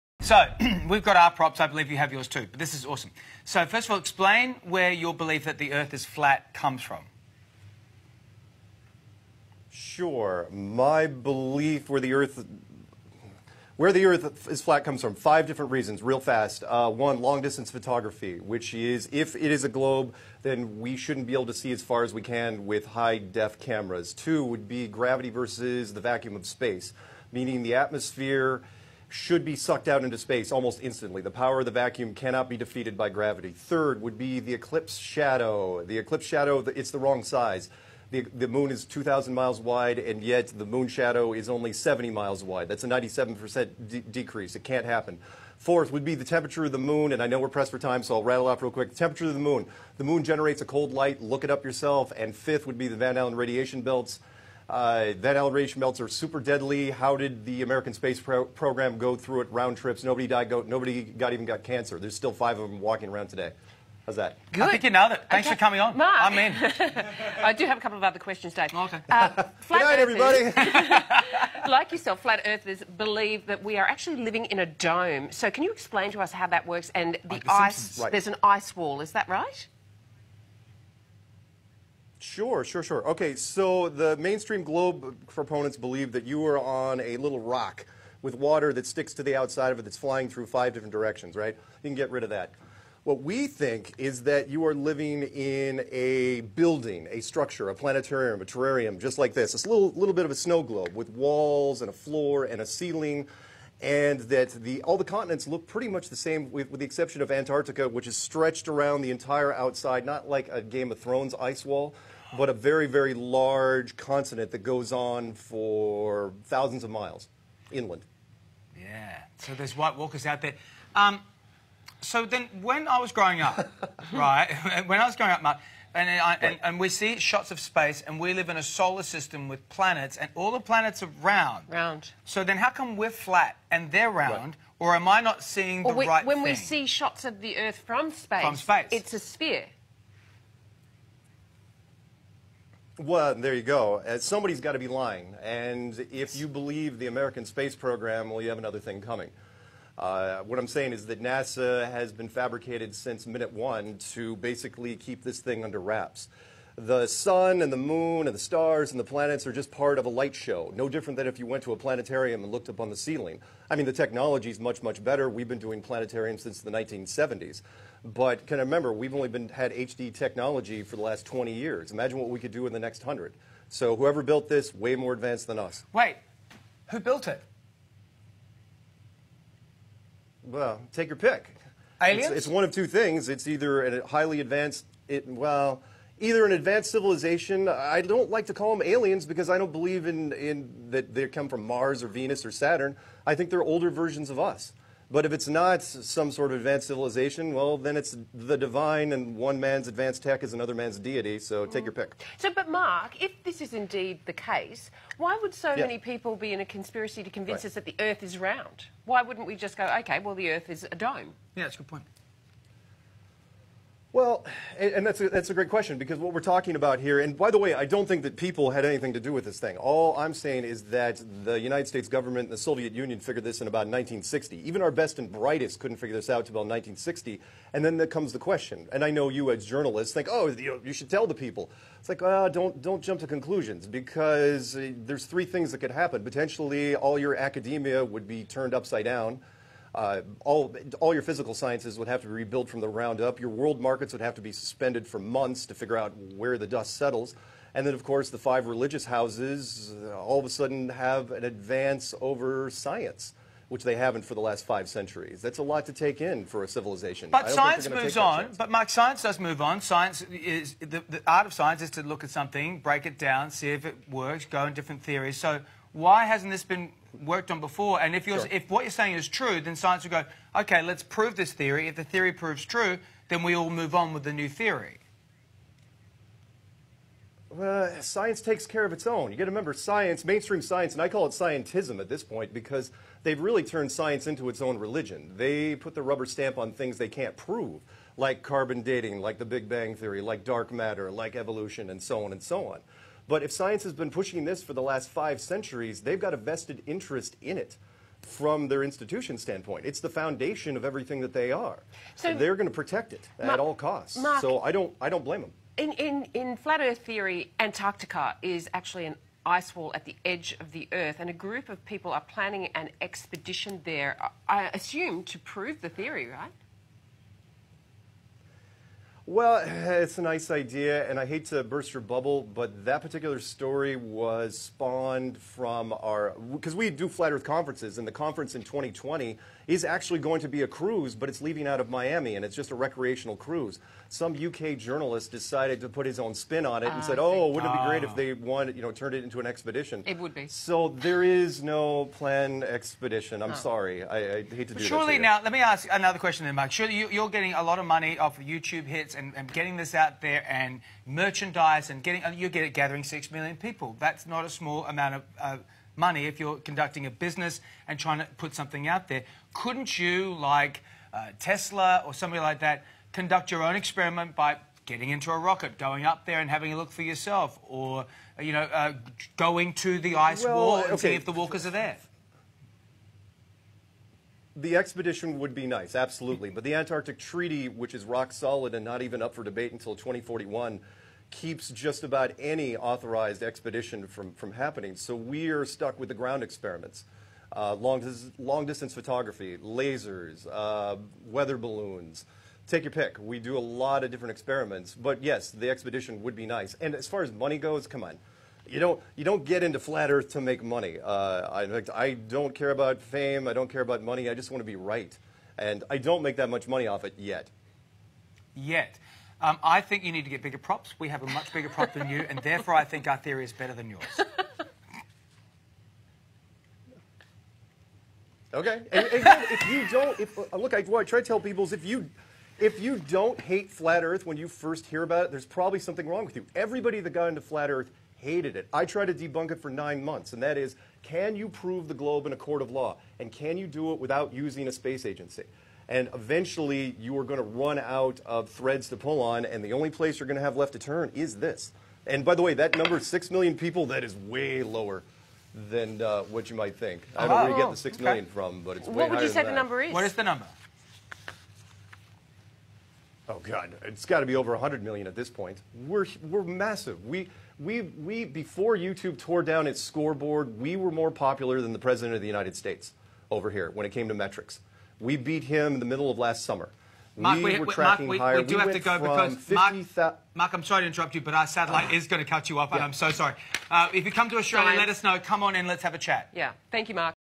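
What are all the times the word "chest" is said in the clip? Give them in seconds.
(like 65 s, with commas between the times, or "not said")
not said.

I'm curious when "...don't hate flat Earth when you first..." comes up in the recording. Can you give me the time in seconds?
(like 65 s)
422 s.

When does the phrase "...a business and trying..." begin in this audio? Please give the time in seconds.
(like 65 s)
357 s.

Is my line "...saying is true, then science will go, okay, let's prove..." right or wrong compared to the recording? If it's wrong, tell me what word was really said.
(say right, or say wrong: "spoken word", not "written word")
right.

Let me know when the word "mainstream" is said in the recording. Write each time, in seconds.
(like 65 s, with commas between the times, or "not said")
84 s, 280 s.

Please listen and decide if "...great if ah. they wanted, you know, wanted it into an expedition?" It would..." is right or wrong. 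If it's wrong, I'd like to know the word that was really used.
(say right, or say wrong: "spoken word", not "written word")
wrong: "turned", not "wanted".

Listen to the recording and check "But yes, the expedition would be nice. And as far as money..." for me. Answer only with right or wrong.
right.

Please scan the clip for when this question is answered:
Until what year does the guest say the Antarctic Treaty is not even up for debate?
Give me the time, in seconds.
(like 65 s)
379 s.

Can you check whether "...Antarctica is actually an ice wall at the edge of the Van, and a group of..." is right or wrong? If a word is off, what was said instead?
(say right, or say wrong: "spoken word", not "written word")
wrong: "Earth", not "Van".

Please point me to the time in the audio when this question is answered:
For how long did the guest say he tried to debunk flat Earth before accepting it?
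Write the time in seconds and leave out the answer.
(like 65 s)
429 s.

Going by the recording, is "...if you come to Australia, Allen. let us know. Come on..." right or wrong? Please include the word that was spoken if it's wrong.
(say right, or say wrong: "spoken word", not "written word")
wrong: "Science", not "Allen".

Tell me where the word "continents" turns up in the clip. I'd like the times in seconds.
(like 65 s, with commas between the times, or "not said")
105 s, 113 s.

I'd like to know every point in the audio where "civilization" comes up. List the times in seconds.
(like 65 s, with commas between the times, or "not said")
186 s, 196 s, 256 s.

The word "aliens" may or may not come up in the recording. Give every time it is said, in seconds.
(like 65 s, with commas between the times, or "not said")
182 s, 188 s.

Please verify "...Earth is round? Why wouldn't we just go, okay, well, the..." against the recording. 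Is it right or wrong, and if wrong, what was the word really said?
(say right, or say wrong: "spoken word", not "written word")
right.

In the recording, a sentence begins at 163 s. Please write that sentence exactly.
I mean, the technology is much, much better.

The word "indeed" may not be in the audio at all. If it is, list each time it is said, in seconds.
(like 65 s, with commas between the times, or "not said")
203 s.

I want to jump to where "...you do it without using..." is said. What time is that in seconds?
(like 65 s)
433 s.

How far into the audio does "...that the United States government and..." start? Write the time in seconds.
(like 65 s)
220 s.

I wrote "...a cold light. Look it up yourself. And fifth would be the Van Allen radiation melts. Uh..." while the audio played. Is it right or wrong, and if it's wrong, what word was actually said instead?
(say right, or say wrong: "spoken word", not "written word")
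wrong: "belts", not "melts".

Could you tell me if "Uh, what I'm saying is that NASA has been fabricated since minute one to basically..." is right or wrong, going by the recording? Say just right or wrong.
right.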